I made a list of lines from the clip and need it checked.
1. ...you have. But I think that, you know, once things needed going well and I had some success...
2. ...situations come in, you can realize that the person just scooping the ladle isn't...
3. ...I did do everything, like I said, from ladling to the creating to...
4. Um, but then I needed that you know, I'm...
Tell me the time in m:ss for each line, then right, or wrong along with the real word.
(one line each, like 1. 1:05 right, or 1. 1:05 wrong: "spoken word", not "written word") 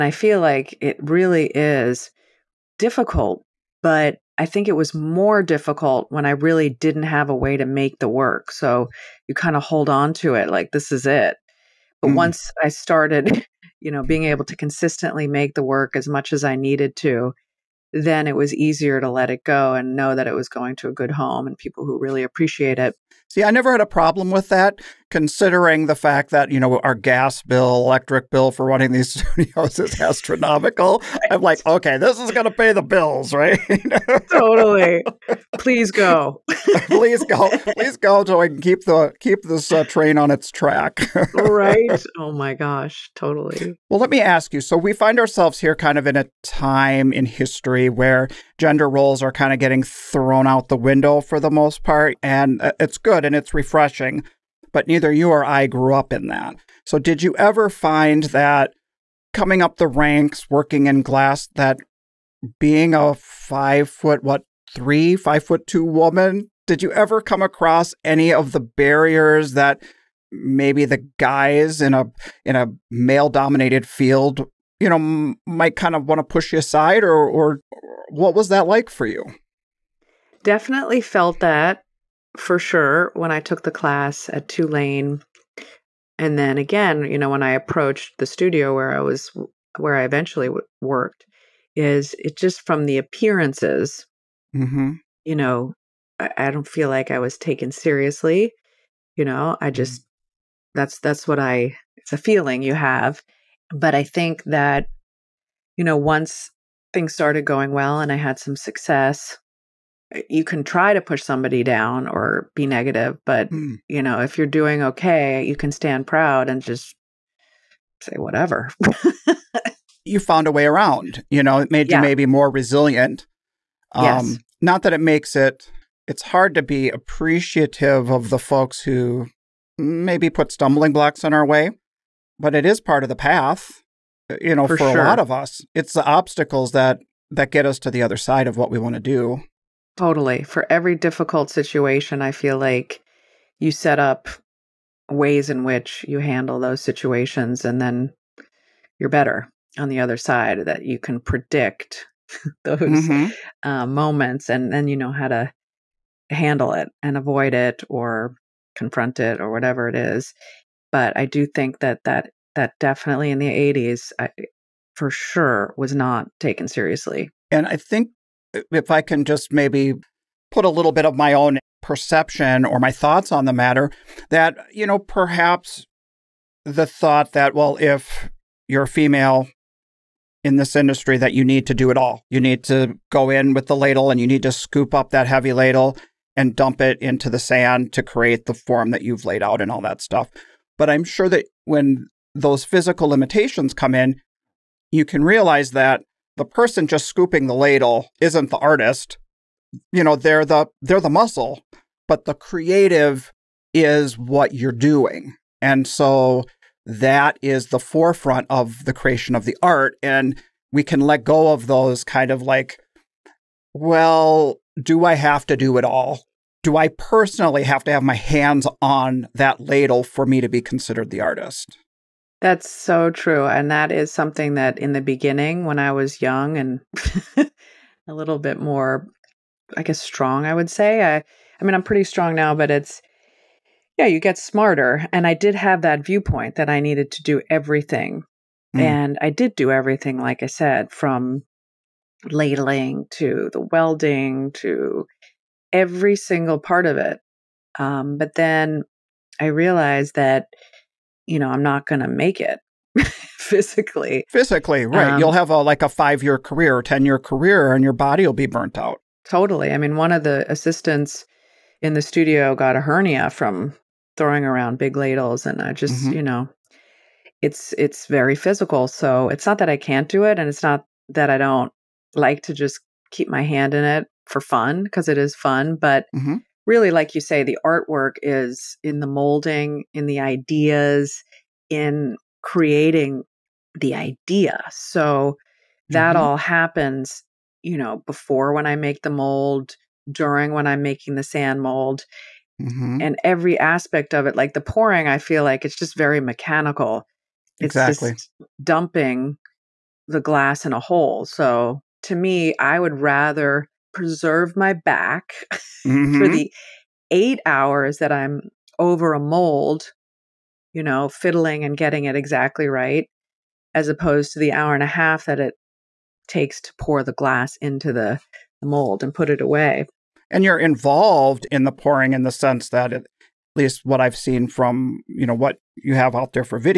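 1. 1:42 wrong: "started", not "needed"
2. 3:13 wrong: "limitations", not "situations"
3. 3:59 wrong: "welding", not "creating"
4. 4:07 wrong: "realized", not "needed".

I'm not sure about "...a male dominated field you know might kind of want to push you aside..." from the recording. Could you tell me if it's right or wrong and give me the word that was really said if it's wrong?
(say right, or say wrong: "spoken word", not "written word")
right.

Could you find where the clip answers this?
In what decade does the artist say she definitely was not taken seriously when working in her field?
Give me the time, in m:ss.
2:43.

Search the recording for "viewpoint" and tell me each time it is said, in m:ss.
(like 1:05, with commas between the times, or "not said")
3:56.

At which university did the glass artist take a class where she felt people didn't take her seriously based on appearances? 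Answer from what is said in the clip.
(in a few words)
Tulane.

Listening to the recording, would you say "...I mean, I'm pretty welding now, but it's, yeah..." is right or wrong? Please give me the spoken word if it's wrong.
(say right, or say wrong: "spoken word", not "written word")
wrong: "strong", not "welding".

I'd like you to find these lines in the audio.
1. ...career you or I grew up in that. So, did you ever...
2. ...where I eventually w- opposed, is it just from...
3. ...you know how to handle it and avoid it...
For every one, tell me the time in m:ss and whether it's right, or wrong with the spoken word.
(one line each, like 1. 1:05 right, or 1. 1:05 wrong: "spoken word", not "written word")
1. 0:54 wrong: "neither", not "career"
2. 1:29 wrong: "worked", not "opposed"
3. 2:34 right.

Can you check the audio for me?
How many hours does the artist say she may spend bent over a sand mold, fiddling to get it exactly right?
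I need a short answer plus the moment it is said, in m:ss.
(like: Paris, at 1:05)
8 hours, at 5:07.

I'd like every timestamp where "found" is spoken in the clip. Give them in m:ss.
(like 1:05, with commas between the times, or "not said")
2:00.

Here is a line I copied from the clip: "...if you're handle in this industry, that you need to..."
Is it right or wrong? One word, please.
wrong.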